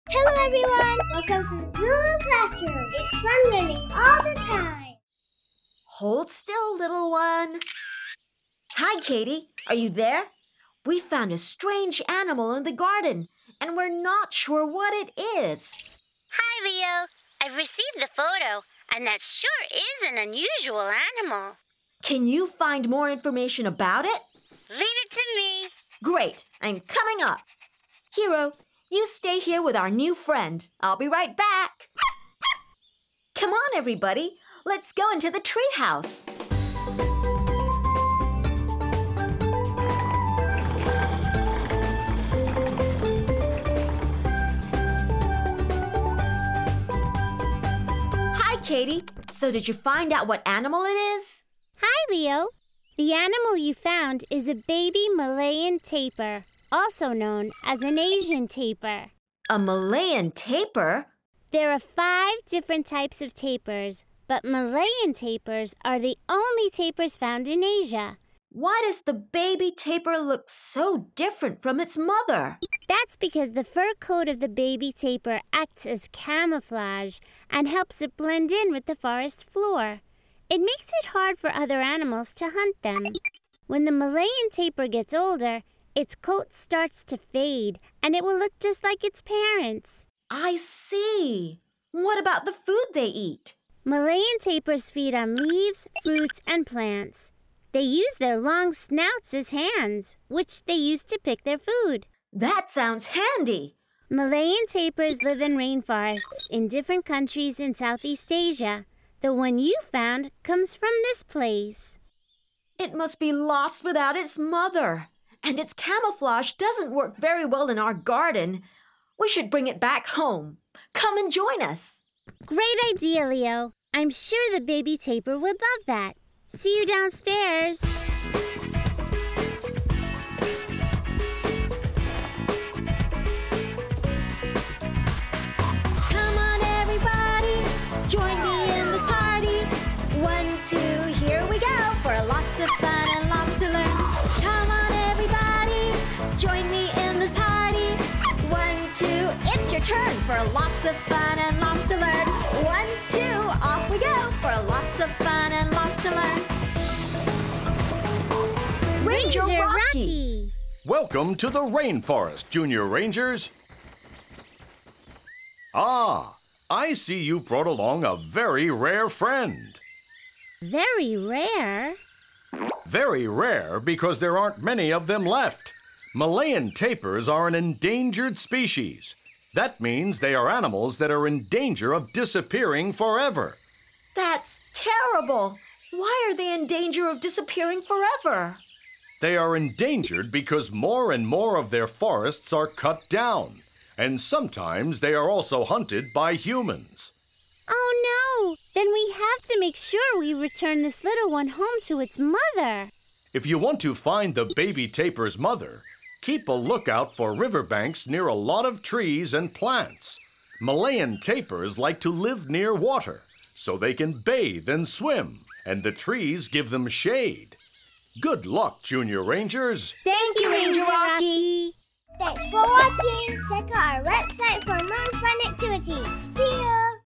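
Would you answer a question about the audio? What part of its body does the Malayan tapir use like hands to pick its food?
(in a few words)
long snouts.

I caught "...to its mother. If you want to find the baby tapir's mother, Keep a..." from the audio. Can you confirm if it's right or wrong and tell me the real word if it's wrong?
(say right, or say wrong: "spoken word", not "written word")
right.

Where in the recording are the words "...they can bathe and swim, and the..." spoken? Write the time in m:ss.
3:33.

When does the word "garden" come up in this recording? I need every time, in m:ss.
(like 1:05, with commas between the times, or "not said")
0:12, 1:57.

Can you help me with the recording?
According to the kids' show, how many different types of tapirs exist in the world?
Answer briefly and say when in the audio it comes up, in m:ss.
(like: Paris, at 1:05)
5, at 1:01.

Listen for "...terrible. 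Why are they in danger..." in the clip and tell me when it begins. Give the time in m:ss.
3:04.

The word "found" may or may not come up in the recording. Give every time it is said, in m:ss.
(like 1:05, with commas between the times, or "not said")
0:10, 0:53, 1:07, 1:49.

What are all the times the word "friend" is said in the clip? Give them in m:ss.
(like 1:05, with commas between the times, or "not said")
0:30, 2:49.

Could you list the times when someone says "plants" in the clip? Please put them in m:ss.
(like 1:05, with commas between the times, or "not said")
1:36, 3:29.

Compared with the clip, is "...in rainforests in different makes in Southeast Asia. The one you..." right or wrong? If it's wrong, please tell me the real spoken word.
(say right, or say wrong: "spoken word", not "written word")
wrong: "countries", not "makes".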